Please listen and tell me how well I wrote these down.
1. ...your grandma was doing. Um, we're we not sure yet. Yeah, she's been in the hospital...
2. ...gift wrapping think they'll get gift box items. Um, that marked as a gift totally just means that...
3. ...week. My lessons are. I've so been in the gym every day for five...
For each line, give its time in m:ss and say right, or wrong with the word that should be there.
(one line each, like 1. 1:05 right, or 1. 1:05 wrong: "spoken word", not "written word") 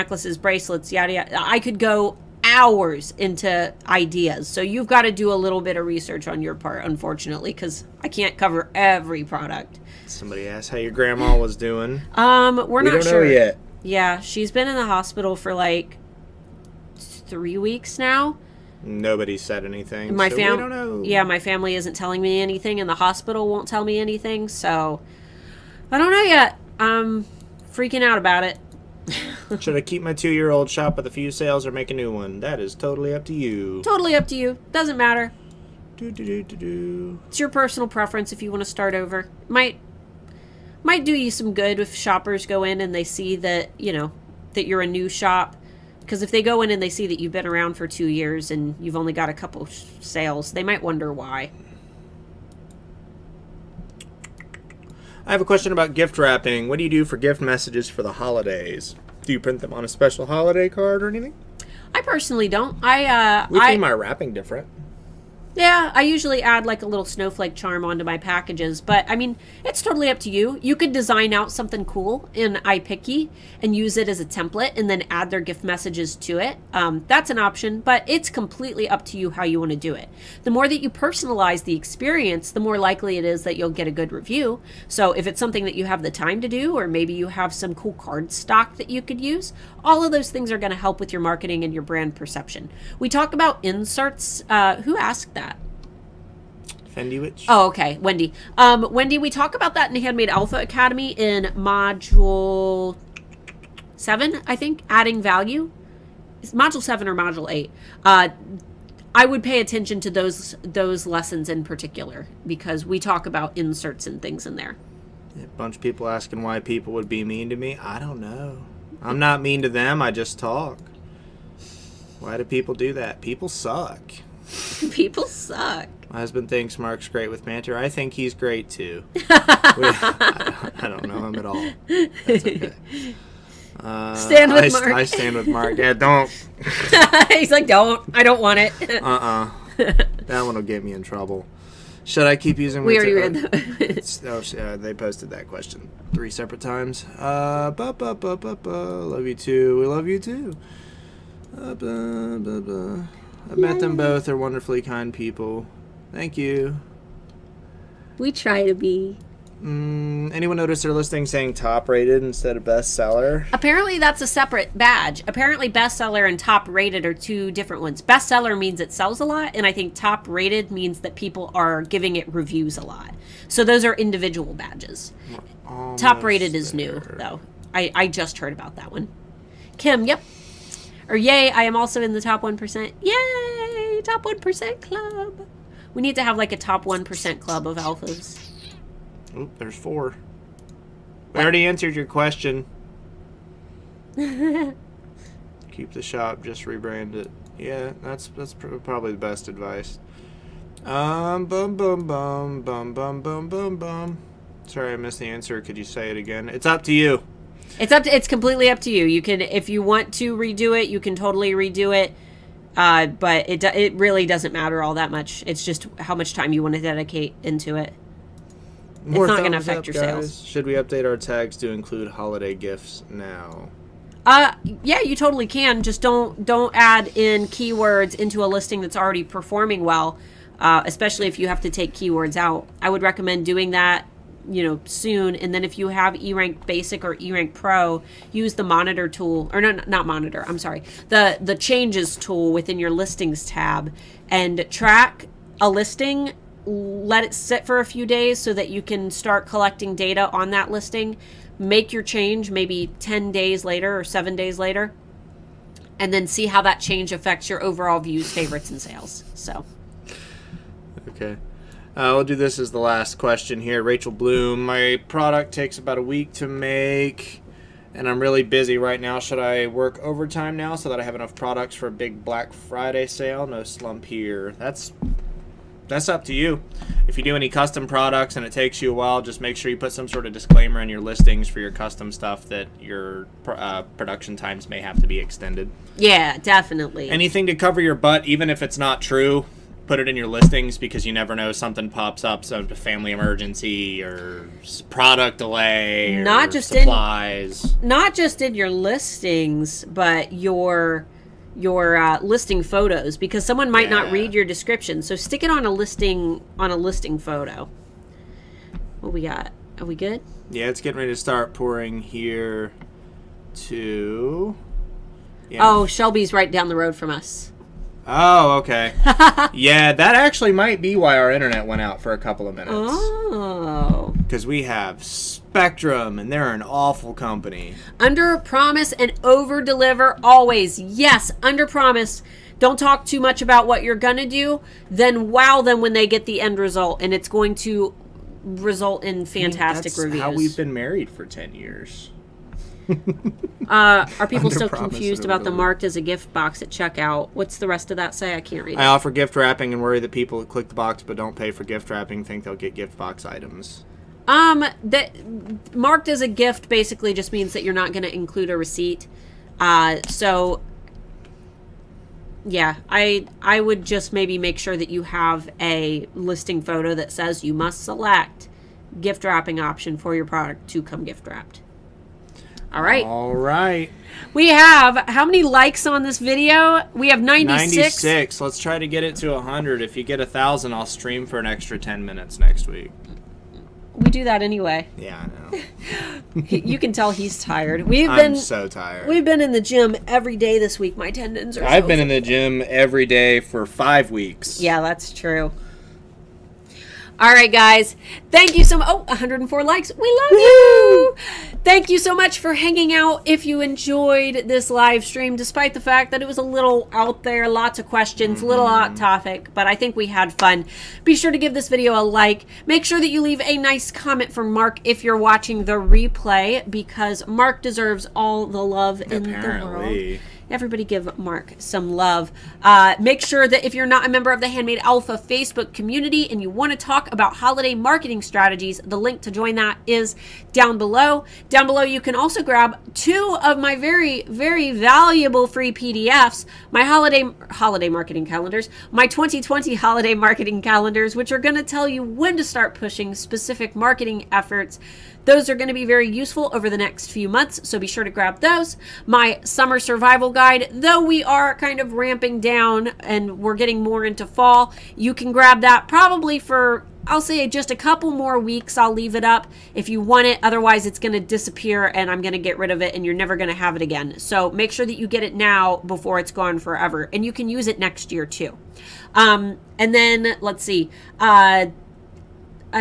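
1. 0:10 right
2. 5:51 wrong: "basically", not "totally"
3. 6:30 wrong: "tendons", not "lessons".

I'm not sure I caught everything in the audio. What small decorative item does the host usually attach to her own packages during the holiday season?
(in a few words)
snowflake charm.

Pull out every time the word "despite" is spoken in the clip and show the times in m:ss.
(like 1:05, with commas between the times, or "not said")
6:45.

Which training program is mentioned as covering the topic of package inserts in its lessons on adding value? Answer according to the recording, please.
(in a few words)
Handmade Alpha Academy.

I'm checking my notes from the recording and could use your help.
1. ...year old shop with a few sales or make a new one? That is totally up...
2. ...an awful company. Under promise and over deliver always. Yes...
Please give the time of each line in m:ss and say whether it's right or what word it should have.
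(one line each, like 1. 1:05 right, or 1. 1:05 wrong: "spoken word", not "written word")
1. 0:30 right
2. 5:26 right.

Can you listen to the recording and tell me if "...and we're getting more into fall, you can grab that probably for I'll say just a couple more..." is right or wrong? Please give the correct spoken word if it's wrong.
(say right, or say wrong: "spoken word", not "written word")
right.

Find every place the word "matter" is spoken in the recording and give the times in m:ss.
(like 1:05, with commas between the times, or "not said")
0:34, 3:34.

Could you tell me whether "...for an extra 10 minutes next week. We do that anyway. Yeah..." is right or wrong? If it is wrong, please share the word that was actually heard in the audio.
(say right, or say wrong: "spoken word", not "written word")
right.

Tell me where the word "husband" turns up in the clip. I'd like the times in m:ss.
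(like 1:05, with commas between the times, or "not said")
2:06.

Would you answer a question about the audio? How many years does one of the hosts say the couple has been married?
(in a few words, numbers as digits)
10.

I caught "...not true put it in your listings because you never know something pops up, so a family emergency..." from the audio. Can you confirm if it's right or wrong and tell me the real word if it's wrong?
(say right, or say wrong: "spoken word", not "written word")
right.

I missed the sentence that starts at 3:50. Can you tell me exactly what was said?
Uh, especially if you have to take keywords out, I would recommend doing that you know, soon.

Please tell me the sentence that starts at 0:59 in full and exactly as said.
Do you print them on a special holiday card or anything?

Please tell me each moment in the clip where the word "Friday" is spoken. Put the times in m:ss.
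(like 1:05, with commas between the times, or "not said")
4:32.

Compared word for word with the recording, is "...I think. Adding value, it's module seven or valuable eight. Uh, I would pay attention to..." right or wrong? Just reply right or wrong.
wrong.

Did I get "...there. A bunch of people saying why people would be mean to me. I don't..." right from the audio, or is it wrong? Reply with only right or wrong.
wrong.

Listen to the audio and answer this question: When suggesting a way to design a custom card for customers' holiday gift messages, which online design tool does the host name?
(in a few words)
iPiccy.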